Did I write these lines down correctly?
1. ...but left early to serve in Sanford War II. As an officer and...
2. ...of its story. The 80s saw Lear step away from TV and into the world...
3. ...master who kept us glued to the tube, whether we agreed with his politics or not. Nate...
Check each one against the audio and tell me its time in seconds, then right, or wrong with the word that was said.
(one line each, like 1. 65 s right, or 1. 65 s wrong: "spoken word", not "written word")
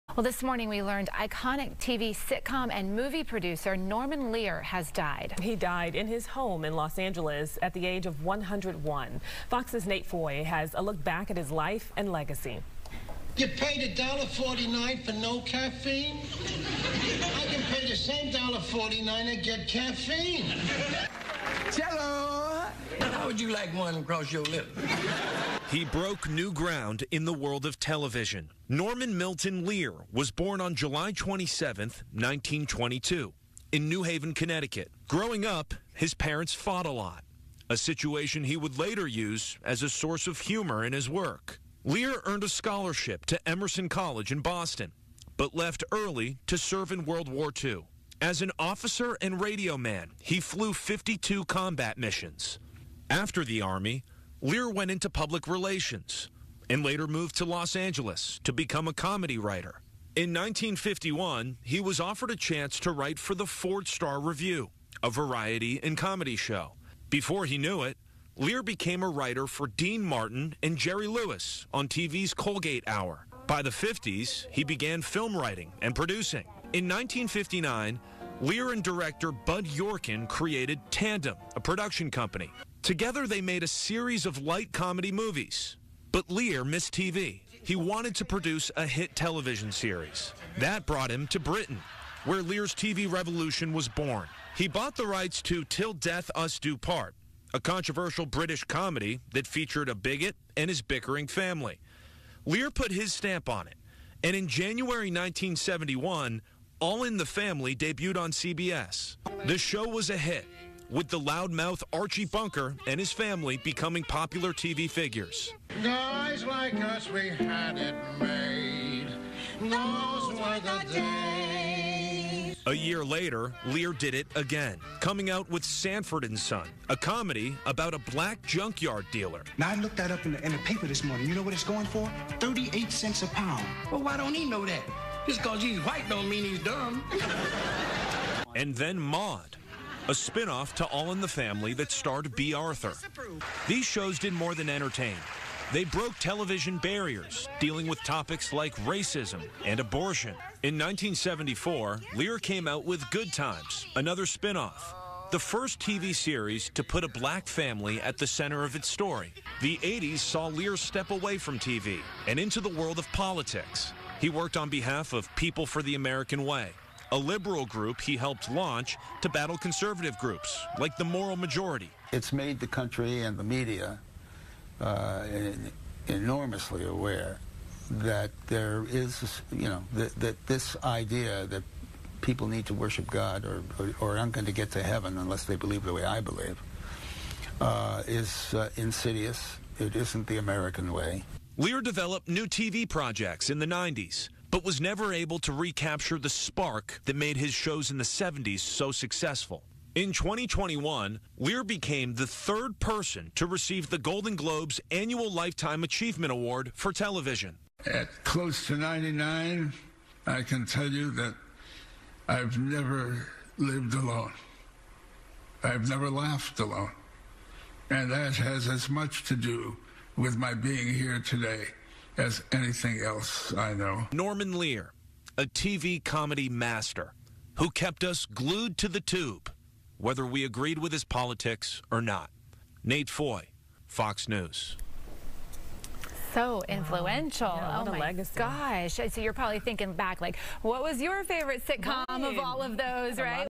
1. 45 s wrong: "World", not "Sanford"
2. 158 s right
3. 226 s right.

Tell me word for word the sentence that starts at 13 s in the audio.
You paid $1.49 for no caffeine?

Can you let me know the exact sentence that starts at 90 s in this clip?
That brought him to Britain, where Lear's TV revolution was born.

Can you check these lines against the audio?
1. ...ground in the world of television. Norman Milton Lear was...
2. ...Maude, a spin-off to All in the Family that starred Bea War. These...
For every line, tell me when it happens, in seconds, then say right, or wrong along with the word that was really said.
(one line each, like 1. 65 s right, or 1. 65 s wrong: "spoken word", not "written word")
1. 26 s right
2. 138 s wrong: "Arthur", not "War".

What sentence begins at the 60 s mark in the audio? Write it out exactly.
In 1951, he was offered a chance to write for the Ford Star Revue, a variety and comedy show.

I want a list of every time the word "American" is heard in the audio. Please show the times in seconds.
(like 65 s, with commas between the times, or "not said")
165 s, 190 s.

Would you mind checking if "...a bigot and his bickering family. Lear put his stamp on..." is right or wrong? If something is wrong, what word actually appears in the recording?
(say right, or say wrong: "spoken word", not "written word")
right.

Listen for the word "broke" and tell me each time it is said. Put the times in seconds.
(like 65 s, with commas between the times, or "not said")
25 s, 145 s.